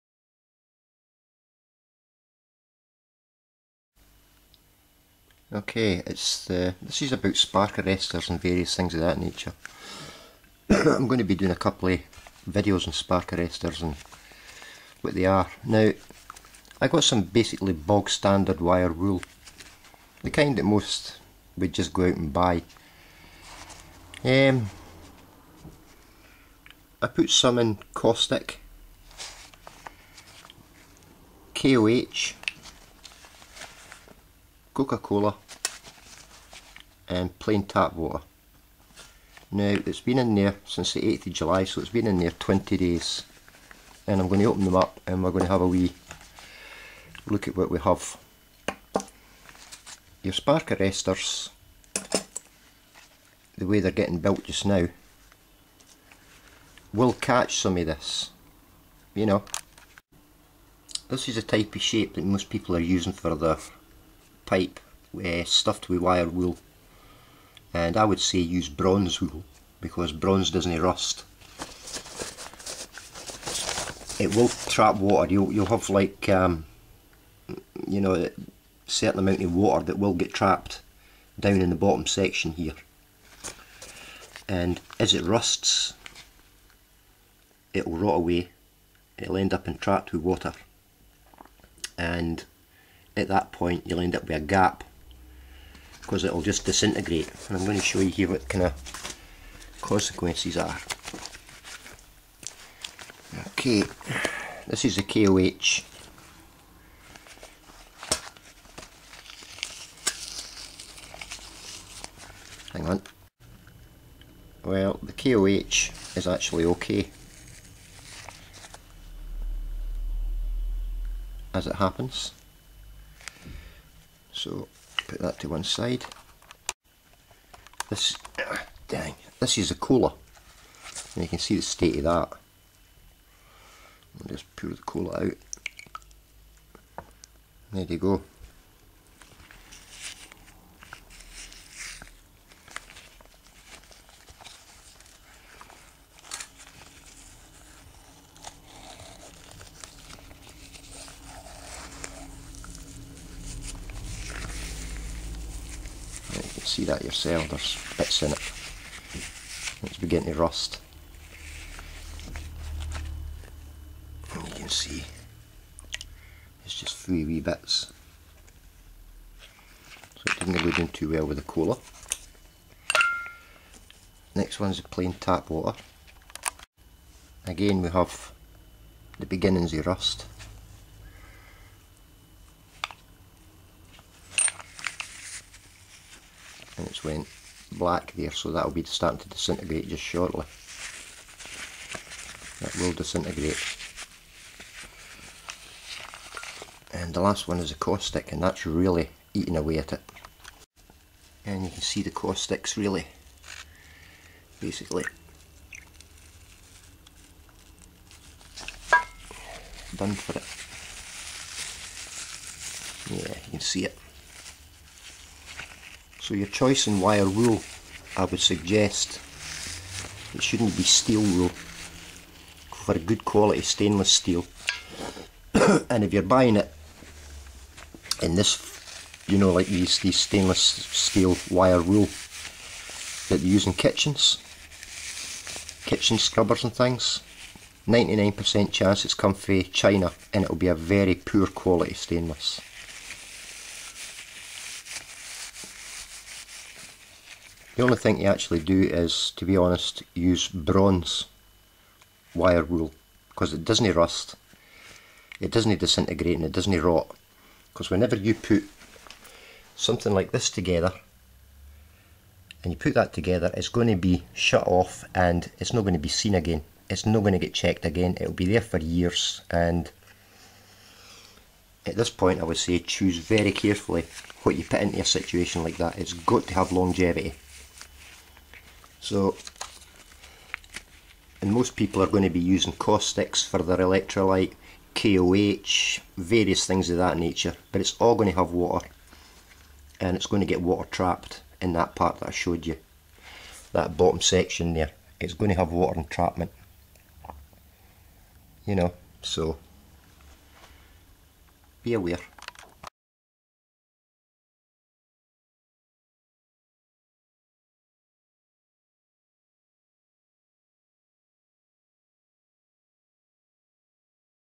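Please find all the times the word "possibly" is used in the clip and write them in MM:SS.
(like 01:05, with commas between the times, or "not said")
not said.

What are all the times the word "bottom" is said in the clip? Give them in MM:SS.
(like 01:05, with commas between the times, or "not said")
01:21, 04:53.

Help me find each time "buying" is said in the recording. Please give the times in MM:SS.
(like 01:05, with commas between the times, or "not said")
03:46.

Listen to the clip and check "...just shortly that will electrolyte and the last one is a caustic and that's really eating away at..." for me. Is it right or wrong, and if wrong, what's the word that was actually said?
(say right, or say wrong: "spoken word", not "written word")
wrong: "disintegrate", not "electrolyte".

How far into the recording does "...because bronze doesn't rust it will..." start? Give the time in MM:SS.
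01:09.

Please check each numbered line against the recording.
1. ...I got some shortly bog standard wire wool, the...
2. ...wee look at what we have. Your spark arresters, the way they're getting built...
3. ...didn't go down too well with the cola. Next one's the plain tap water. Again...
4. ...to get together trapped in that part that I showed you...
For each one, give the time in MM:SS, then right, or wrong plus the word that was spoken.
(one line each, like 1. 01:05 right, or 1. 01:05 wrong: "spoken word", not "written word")
1. 00:16 wrong: "basically", not "shortly"
2. 00:45 right
3. 02:50 right
4. 04:50 wrong: "water", not "together".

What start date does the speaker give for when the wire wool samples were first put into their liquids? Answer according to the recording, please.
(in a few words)
8th of July.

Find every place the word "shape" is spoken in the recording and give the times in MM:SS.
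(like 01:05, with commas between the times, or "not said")
01:01.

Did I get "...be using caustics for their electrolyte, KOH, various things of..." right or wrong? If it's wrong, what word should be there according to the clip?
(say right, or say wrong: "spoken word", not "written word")
right.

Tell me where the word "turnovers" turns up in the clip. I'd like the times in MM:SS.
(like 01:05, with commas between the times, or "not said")
not said.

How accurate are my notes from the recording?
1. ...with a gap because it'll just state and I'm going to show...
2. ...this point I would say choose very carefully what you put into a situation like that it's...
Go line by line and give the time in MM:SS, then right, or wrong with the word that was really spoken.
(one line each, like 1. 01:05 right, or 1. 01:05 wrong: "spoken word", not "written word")
1. 01:34 wrong: "disintegrate", not "state"
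2. 04:31 right.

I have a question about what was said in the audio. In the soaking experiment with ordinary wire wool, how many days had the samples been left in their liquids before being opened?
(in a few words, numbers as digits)
20.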